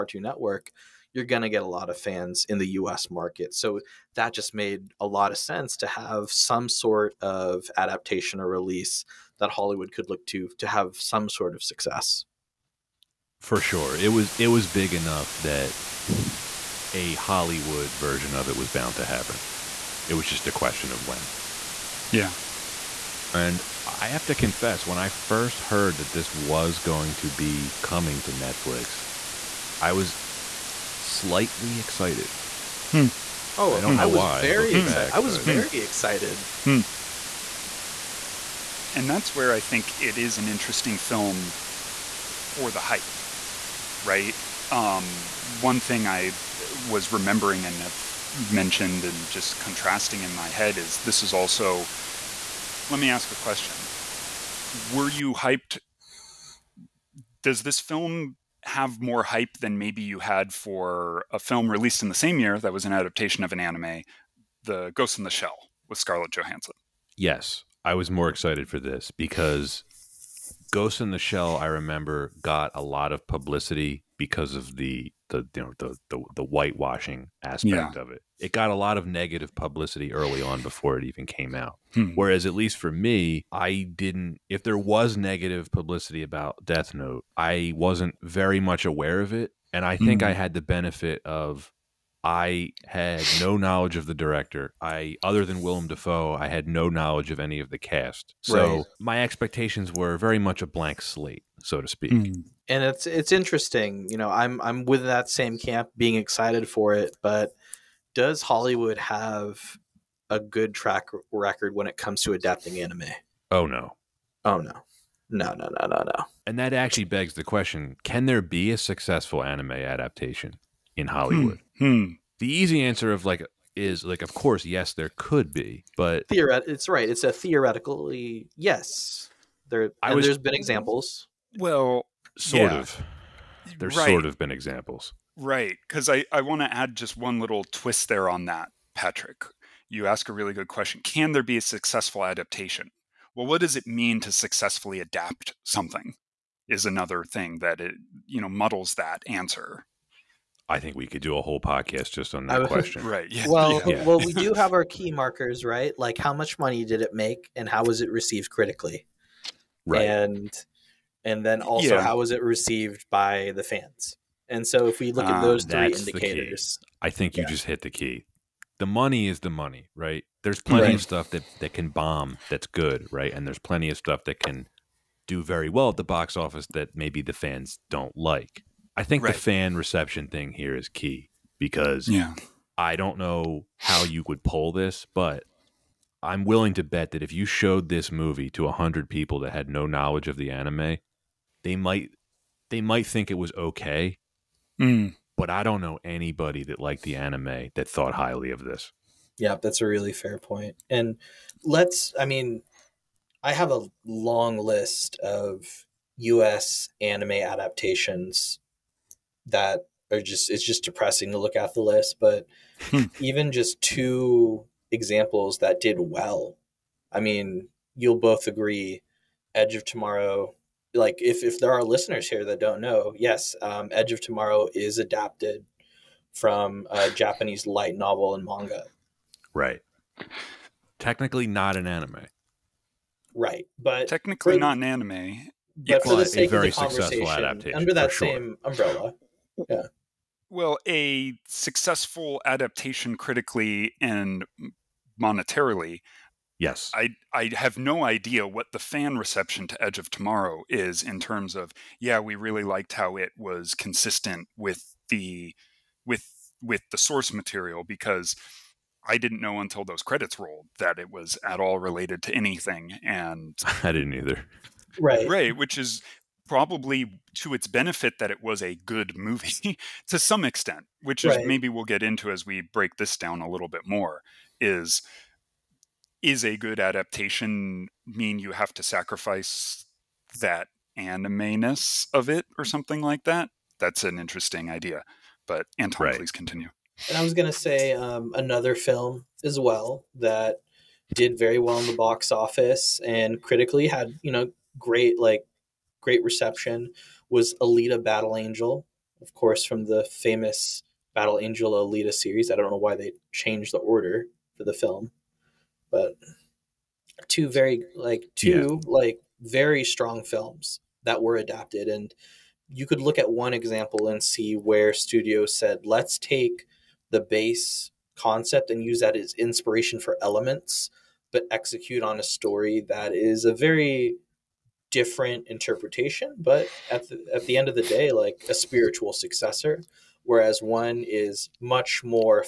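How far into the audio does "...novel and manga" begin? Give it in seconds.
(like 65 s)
227 s.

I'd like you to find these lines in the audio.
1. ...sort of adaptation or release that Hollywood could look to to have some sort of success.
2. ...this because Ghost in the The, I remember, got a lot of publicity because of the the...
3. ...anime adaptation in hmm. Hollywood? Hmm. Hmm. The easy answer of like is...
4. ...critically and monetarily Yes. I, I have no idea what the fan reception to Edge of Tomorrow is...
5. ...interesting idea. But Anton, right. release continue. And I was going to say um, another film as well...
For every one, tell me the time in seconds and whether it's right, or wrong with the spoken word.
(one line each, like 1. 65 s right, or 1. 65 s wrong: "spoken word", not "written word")
1. 6 s right
2. 68 s wrong: "Shell", not "The"
3. 119 s right
4. 243 s right
5. 284 s wrong: "please", not "release".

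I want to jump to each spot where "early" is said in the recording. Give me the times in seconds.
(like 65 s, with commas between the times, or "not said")
80 s.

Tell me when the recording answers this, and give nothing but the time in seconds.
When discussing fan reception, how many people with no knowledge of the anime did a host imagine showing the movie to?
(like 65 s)
188 s.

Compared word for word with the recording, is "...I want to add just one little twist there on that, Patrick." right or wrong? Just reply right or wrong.
right.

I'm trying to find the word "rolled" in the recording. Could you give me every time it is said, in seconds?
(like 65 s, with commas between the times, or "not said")
260 s.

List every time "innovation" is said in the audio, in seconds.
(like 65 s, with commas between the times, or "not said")
not said.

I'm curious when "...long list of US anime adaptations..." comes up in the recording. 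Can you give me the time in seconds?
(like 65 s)
204 s.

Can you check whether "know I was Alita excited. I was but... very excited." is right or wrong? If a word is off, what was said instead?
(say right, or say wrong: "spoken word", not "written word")
wrong: "Very", not "Alita".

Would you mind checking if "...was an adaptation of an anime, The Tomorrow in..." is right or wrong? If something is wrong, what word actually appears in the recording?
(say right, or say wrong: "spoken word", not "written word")
wrong: "Ghost", not "Tomorrow".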